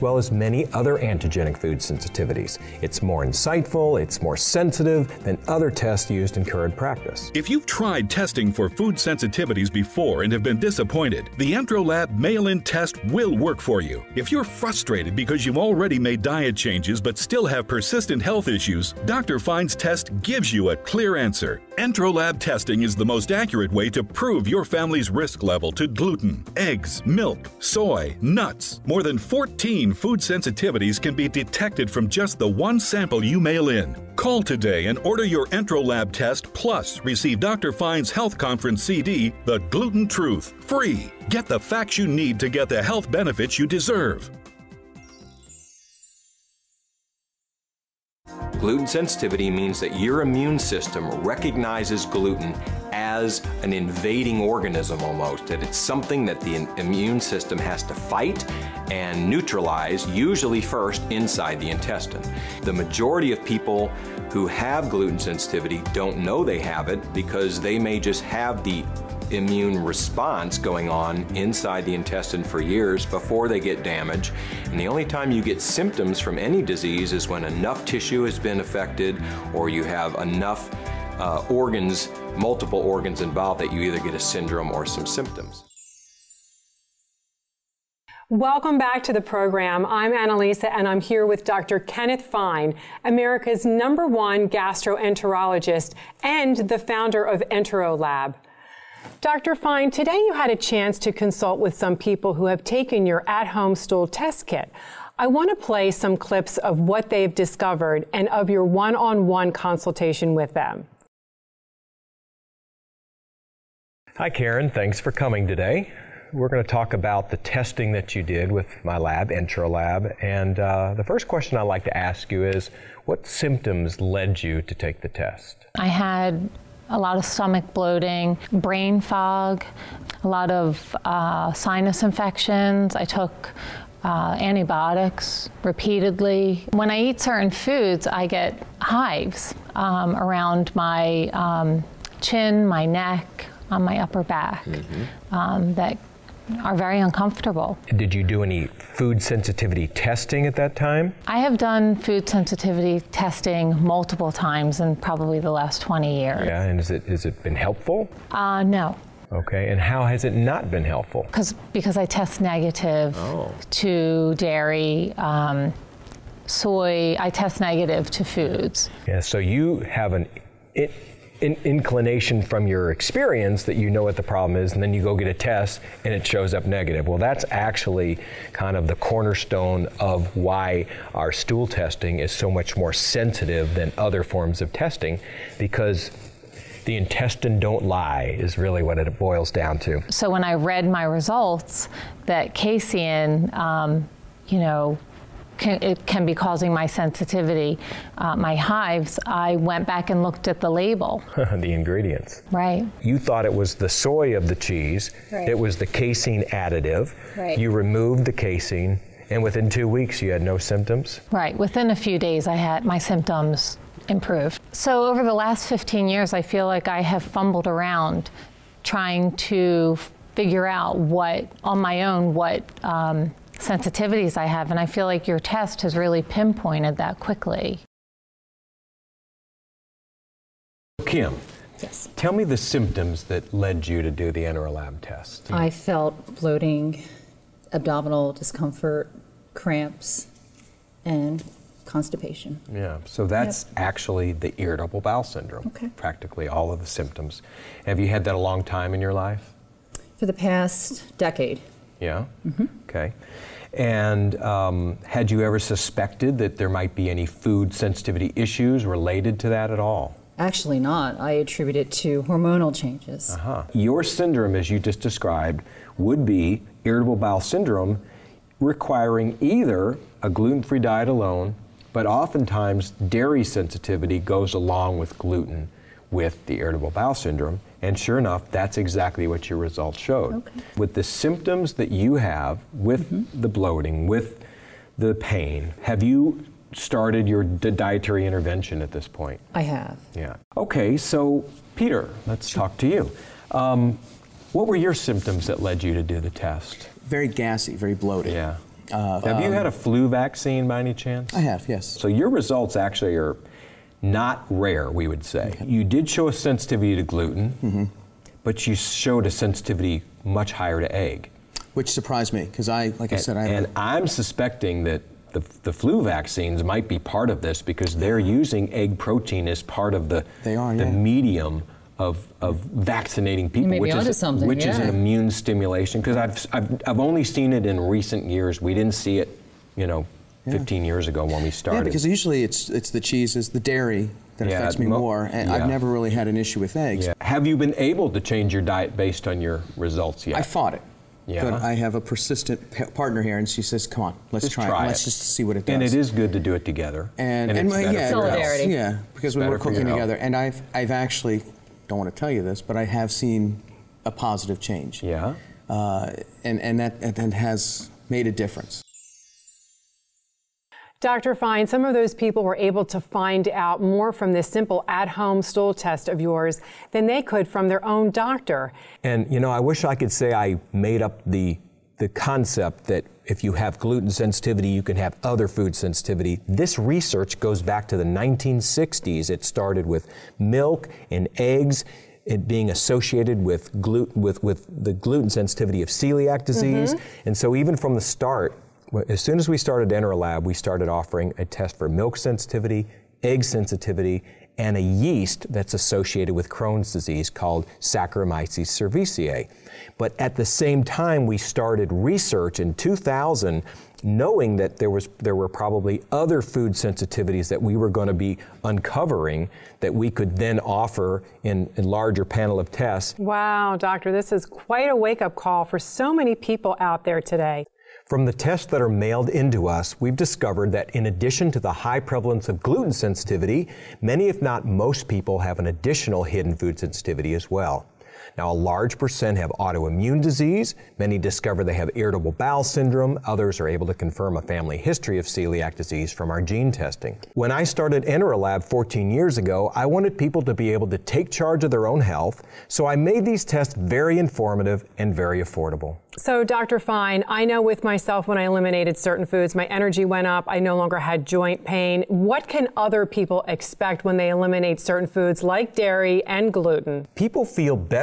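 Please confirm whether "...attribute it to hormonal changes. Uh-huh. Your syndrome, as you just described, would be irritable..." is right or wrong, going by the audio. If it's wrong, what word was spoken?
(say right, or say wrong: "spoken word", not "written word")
right.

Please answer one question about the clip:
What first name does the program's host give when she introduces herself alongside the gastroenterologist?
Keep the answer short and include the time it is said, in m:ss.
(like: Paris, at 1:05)
Annalisa, at 1:30.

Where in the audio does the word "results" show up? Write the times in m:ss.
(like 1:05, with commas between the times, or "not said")
3:11, 4:39, 5:02, 5:39.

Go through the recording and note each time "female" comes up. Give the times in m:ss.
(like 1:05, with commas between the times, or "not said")
not said.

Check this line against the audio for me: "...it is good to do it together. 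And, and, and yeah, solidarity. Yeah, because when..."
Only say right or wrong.
right.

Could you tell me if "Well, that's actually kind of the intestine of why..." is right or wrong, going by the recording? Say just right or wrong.
wrong.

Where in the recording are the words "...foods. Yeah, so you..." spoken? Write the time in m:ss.
2:48.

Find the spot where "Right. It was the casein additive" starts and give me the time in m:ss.
3:25.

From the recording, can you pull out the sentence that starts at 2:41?
Because because I test negative oh.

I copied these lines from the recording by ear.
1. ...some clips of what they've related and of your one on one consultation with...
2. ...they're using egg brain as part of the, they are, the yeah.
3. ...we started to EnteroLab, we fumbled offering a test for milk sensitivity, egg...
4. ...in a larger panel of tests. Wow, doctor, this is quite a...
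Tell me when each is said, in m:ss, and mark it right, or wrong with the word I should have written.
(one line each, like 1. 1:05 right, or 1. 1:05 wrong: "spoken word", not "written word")
1. 1:45 wrong: "discovered", not "related"
2. 5:17 wrong: "protein", not "brain"
3. 6:29 wrong: "started", not "fumbled"
4. 6:51 right.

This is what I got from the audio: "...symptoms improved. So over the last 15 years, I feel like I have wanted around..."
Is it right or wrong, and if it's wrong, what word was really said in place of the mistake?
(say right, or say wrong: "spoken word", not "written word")
wrong: "fumbled", not "wanted".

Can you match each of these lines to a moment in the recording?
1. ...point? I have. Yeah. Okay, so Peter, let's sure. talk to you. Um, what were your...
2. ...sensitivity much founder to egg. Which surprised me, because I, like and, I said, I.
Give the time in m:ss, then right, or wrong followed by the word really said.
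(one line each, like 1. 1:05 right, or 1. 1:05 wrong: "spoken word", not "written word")
1. 4:49 right
2. 5:09 wrong: "higher", not "founder".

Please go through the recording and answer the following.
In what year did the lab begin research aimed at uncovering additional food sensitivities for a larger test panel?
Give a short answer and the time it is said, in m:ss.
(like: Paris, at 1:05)
2000, at 6:42.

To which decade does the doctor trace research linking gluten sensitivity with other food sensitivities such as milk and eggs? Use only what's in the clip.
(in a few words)
1960s.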